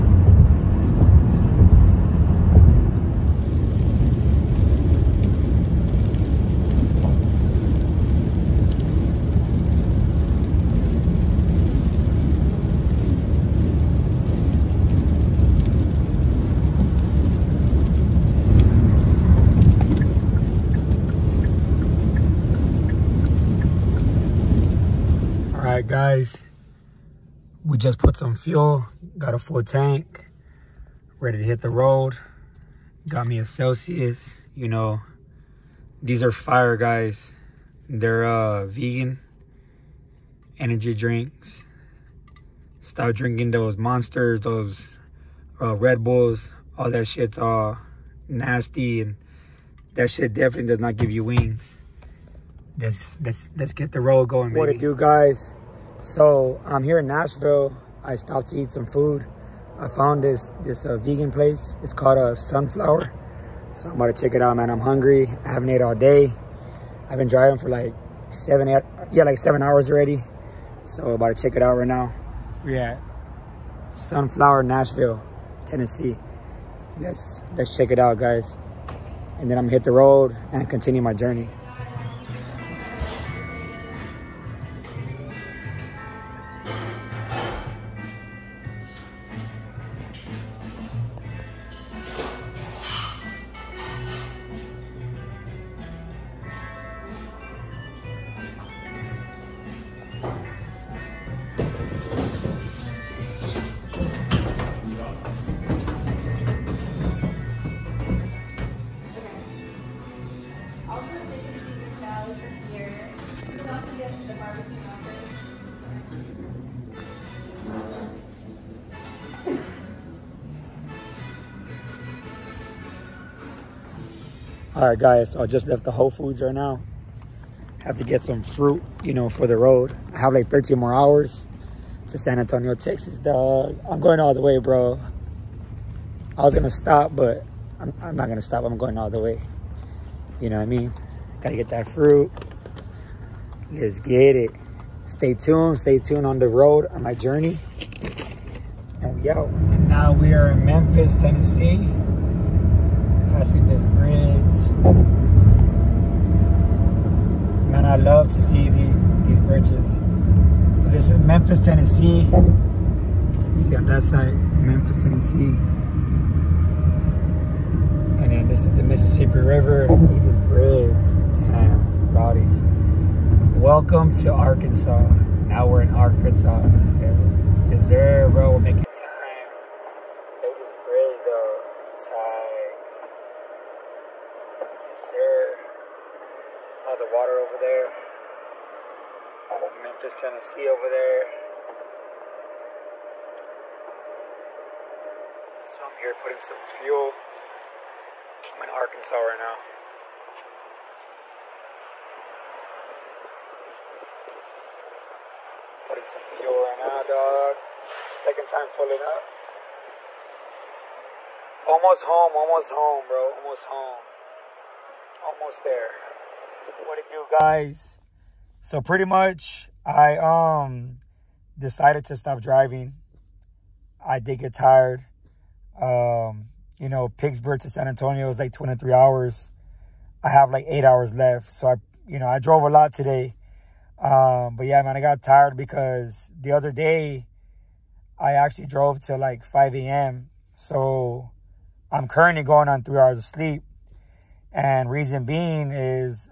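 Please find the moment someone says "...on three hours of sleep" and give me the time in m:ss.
4:02.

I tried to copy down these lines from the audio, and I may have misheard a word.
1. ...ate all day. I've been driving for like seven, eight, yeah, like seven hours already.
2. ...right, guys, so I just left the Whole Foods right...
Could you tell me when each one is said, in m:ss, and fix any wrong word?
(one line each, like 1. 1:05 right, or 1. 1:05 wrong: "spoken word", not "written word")
1. 1:05 right
2. 2:04 right.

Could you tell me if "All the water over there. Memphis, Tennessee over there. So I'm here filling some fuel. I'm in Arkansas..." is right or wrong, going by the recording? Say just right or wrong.
wrong.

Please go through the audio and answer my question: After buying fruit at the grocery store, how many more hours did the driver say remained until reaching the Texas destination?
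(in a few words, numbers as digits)
13.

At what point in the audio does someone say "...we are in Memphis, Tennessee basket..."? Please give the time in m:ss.
2:30.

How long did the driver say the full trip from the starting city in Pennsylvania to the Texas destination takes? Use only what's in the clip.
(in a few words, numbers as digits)
23 hours.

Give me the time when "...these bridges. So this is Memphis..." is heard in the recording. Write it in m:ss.
2:39.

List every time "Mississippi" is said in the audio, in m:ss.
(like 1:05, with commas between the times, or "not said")
2:48.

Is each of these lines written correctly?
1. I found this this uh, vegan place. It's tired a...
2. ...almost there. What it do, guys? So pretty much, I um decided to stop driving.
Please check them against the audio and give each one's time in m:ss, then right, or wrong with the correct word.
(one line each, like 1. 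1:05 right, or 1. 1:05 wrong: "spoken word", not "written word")
1. 0:59 wrong: "called", not "tired"
2. 3:35 right.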